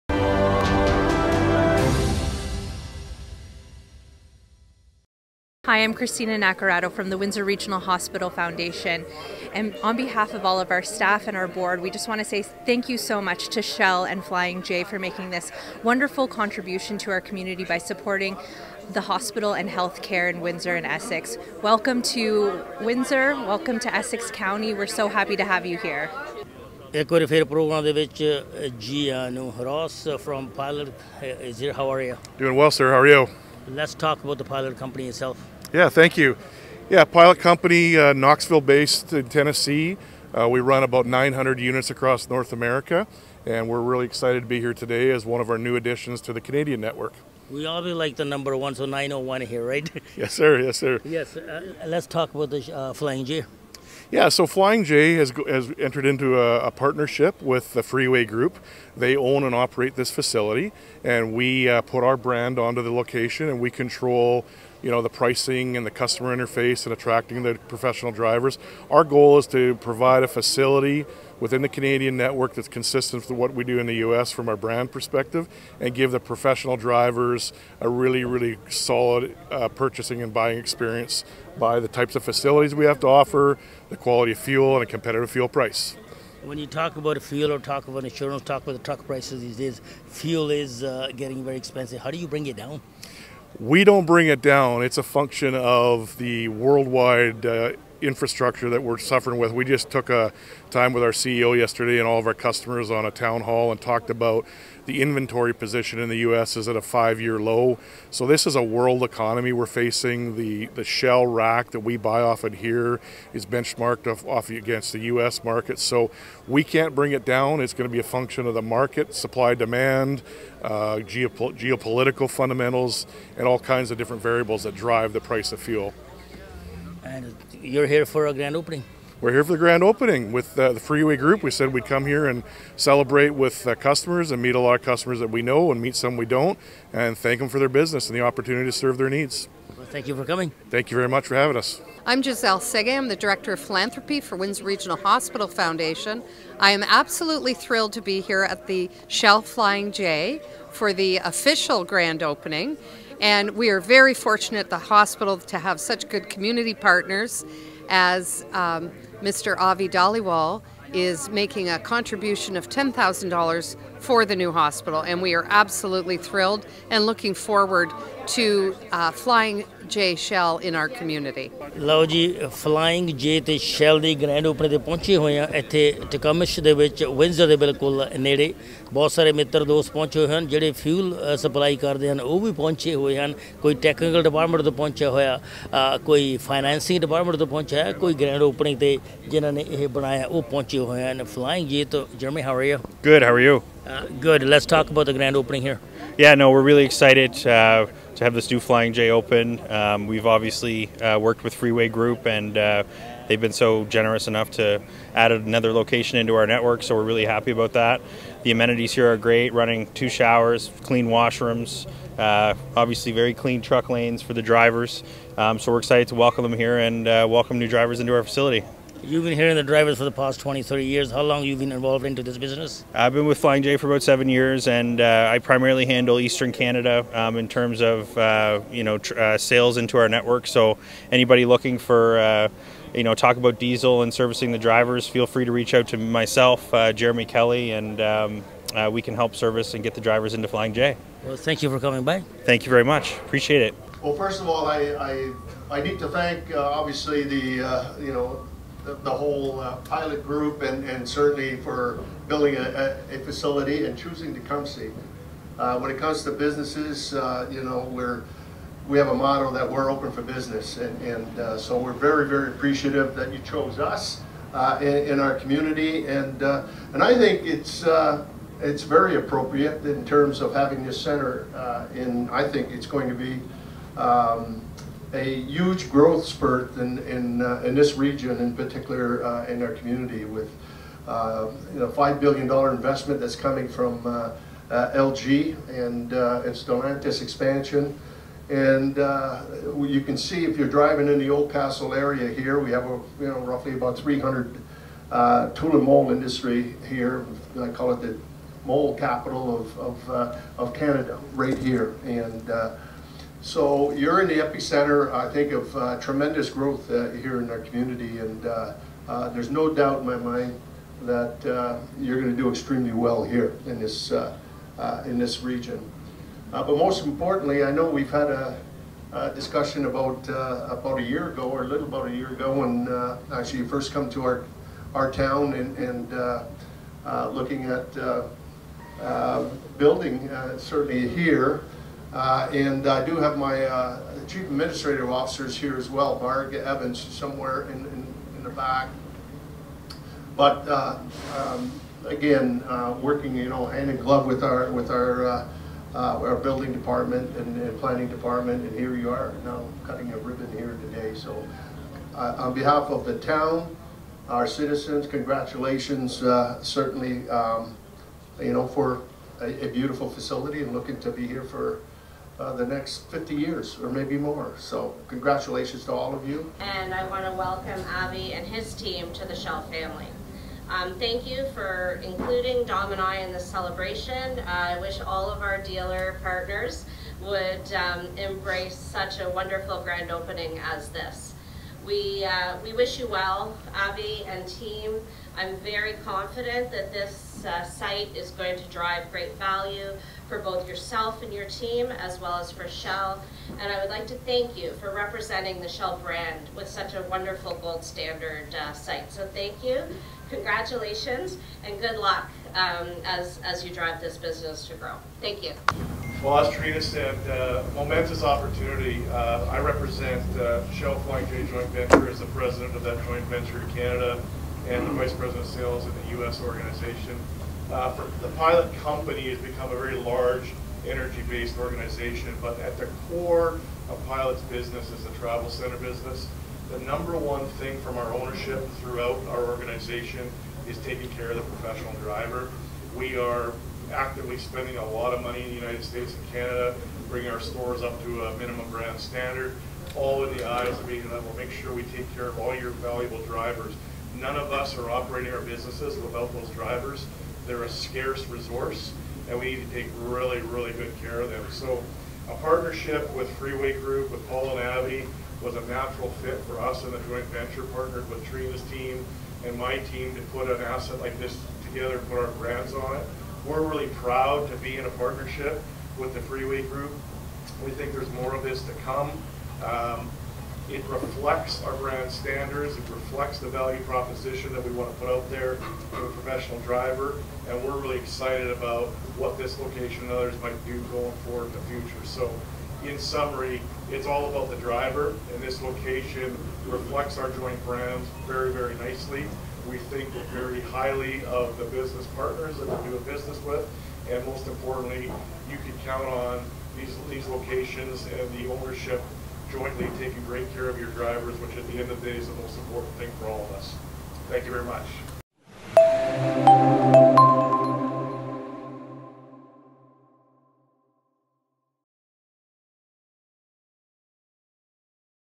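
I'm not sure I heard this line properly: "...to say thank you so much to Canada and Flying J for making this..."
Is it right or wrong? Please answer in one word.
wrong.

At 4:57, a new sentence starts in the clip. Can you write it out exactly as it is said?
I call it the mold capital of, of, of Canada, right here.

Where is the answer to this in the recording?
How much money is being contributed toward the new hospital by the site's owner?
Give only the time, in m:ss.
2:42.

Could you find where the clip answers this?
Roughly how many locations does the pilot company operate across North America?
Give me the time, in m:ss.
0:41.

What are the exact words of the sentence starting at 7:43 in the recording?
We're really proud to be in a partnership with the Freeway Group.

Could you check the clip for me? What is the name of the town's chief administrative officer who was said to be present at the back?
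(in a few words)
Marg Evans.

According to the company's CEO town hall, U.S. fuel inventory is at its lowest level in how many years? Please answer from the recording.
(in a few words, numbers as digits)
5 years.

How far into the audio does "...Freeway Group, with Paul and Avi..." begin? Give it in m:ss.
7:33.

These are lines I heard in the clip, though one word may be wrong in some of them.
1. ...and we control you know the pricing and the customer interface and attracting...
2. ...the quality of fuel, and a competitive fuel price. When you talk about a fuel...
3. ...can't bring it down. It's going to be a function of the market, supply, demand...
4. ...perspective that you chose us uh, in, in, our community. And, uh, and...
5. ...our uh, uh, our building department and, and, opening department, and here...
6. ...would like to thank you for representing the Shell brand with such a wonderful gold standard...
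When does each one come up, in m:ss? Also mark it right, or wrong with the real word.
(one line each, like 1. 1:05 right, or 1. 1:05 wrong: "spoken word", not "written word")
1. 1:03 right
2. 1:23 right
3. 1:56 right
4. 4:22 wrong: "appreciative", not "perspective"
5. 5:44 wrong: "planning", not "opening"
6. 6:33 right.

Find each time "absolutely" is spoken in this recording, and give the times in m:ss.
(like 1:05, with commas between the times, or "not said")
2:26, 2:45.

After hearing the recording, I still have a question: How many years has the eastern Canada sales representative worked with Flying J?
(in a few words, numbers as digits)
7 years.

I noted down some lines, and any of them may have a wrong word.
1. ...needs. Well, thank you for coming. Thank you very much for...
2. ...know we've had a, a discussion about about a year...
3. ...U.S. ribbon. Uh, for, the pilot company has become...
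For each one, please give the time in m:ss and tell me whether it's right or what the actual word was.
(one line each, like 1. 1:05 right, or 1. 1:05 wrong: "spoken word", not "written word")
1. 2:19 right
2. 5:17 right
3. 6:56 wrong: "organization", not "ribbon".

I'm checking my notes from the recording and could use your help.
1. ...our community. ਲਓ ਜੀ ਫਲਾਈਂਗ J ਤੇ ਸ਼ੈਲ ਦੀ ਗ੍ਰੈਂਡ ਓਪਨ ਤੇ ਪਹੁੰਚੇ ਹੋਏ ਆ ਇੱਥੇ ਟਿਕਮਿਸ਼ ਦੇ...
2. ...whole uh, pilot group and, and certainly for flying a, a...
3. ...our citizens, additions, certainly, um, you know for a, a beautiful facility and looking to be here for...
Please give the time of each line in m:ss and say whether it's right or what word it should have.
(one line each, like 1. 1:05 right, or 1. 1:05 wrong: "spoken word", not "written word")
1. 2:50 right
2. 4:09 wrong: "building", not "flying"
3. 5:54 wrong: "congratulations", not "additions".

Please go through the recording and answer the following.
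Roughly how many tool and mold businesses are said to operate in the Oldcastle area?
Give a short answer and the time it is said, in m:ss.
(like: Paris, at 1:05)
300, at 4:53.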